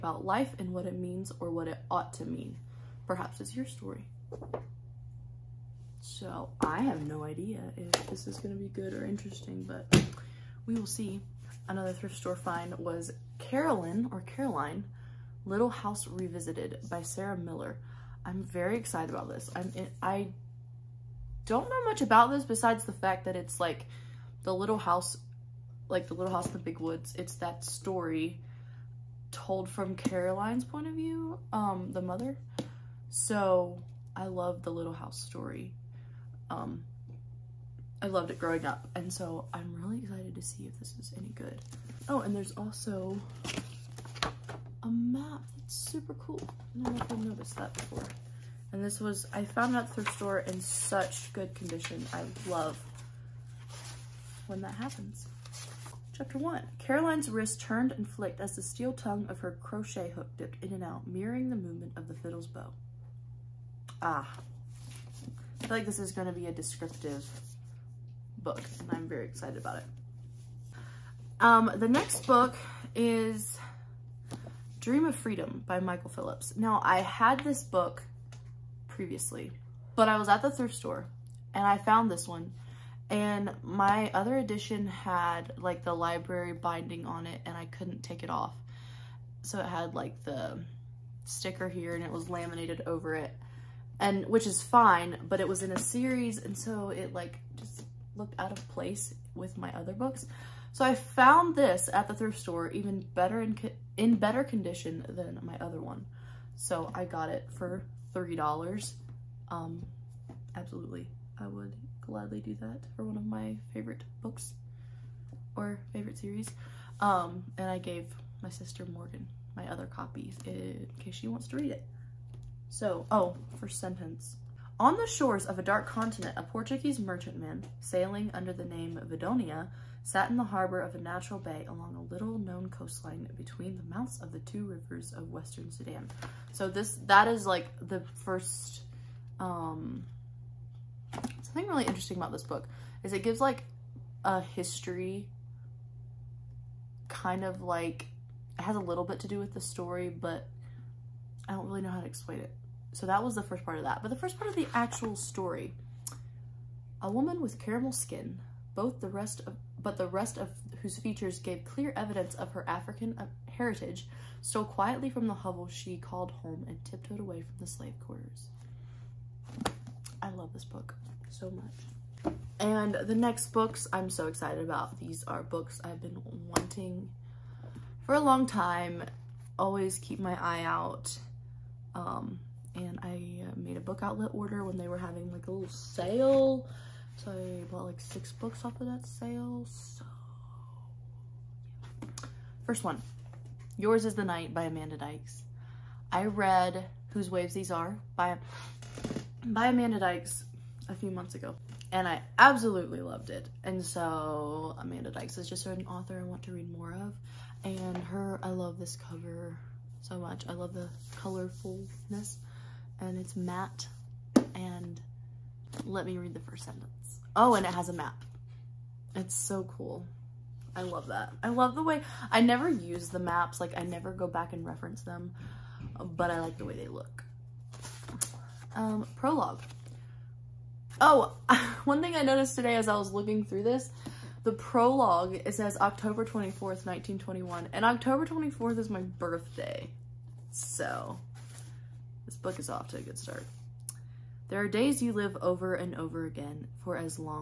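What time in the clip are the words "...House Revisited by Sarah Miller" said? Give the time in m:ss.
0:15.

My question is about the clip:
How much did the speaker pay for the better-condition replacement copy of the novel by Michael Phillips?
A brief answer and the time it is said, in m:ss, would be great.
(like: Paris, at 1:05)
3 dollars, at 1:48.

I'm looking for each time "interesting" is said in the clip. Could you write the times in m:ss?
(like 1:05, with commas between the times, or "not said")
0:09, 2:21.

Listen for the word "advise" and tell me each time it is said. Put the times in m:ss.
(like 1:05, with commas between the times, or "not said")
not said.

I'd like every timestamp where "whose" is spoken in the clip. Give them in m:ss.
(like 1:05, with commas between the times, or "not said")
2:40, 3:17.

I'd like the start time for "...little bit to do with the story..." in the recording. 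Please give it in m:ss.
2:28.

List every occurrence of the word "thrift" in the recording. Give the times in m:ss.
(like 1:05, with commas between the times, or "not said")
0:11, 0:49, 1:20, 1:42.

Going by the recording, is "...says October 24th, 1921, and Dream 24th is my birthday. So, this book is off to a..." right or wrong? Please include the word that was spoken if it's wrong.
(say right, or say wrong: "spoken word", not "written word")
wrong: "October", not "Dream".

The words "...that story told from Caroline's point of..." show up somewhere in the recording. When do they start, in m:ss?
0:27.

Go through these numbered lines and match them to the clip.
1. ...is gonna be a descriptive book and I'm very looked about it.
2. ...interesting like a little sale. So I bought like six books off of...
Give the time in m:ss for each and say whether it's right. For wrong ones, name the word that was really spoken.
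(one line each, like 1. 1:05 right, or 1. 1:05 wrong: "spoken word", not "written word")
1. 1:05 wrong: "excited", not "looked"
2. 3:04 wrong: "having", not "interesting".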